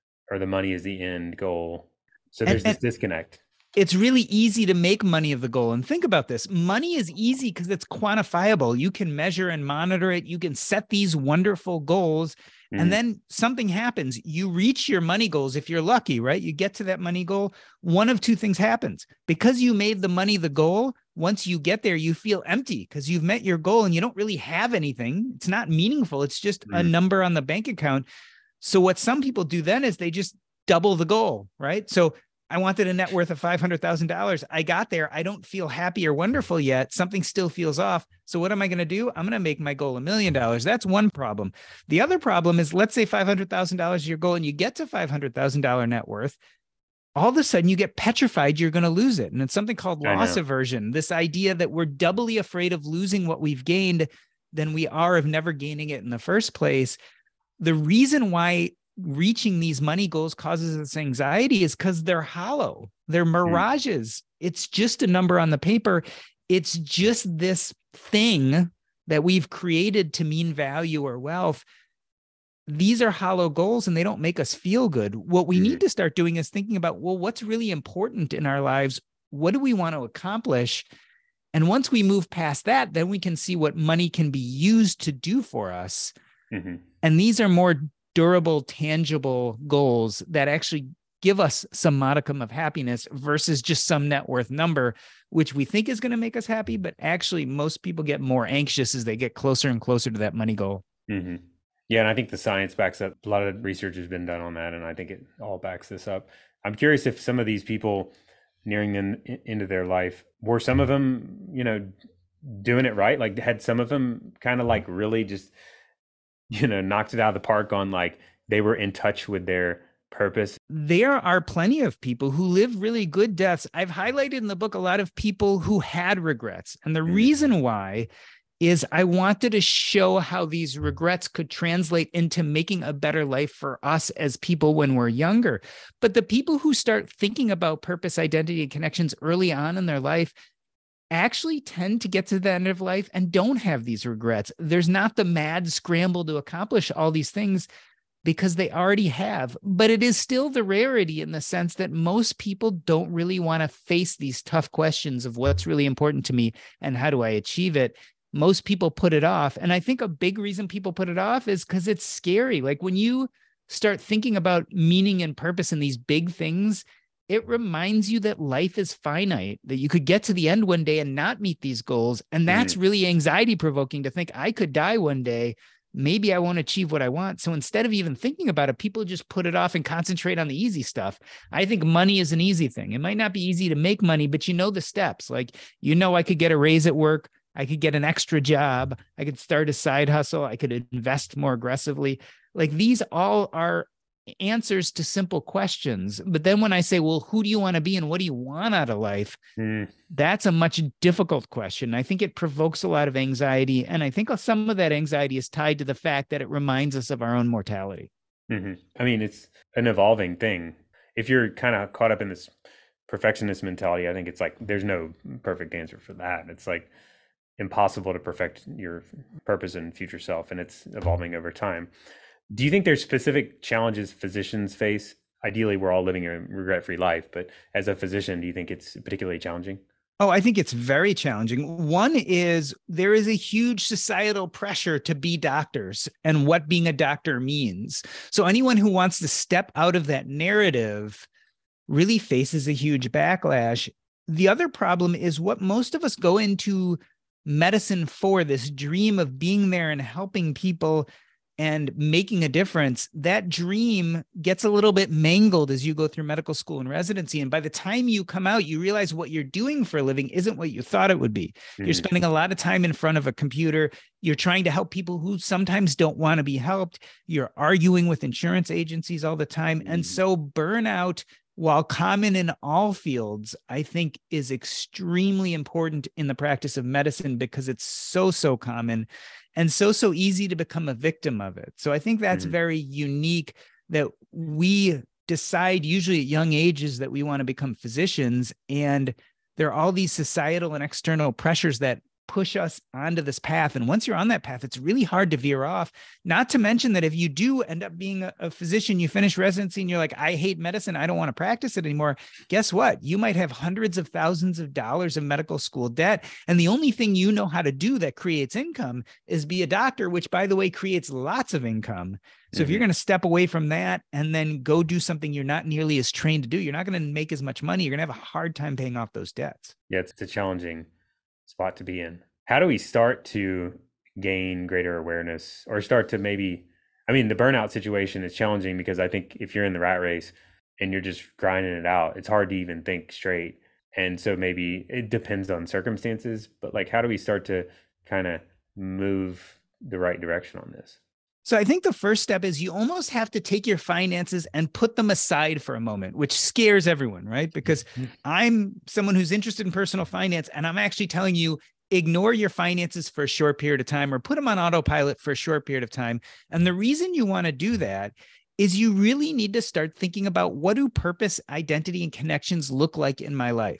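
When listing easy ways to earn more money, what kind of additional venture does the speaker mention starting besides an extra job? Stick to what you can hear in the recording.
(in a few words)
side hustle.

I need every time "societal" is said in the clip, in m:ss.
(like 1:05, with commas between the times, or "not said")
3:53, 4:50.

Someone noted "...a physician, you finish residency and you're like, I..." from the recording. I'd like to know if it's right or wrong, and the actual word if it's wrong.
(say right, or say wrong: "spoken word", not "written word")
right.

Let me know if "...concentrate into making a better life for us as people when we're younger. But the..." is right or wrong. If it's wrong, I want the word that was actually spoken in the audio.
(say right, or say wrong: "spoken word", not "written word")
wrong: "translate", not "concentrate".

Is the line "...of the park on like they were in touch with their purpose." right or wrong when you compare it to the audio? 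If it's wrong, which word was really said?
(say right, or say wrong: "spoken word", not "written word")
right.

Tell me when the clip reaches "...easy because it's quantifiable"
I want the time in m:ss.
0:07.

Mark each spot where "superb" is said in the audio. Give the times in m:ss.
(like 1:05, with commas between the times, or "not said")
not said.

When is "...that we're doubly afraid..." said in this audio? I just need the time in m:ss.
0:51.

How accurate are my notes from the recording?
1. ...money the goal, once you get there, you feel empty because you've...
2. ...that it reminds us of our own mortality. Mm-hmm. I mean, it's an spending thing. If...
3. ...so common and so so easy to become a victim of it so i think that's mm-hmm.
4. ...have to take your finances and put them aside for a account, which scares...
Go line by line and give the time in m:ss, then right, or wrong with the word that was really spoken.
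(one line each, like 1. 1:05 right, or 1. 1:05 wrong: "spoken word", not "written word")
1. 0:20 right
2. 3:26 wrong: "evolving", not "spending"
3. 4:38 right
4. 5:43 wrong: "moment", not "account".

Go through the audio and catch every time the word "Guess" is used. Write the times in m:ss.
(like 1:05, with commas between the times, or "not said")
5:02.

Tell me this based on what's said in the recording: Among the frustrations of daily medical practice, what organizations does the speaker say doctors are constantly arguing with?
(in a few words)
insurance agencies.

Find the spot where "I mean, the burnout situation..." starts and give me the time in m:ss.
5:27.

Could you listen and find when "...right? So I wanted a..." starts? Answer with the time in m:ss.
0:31.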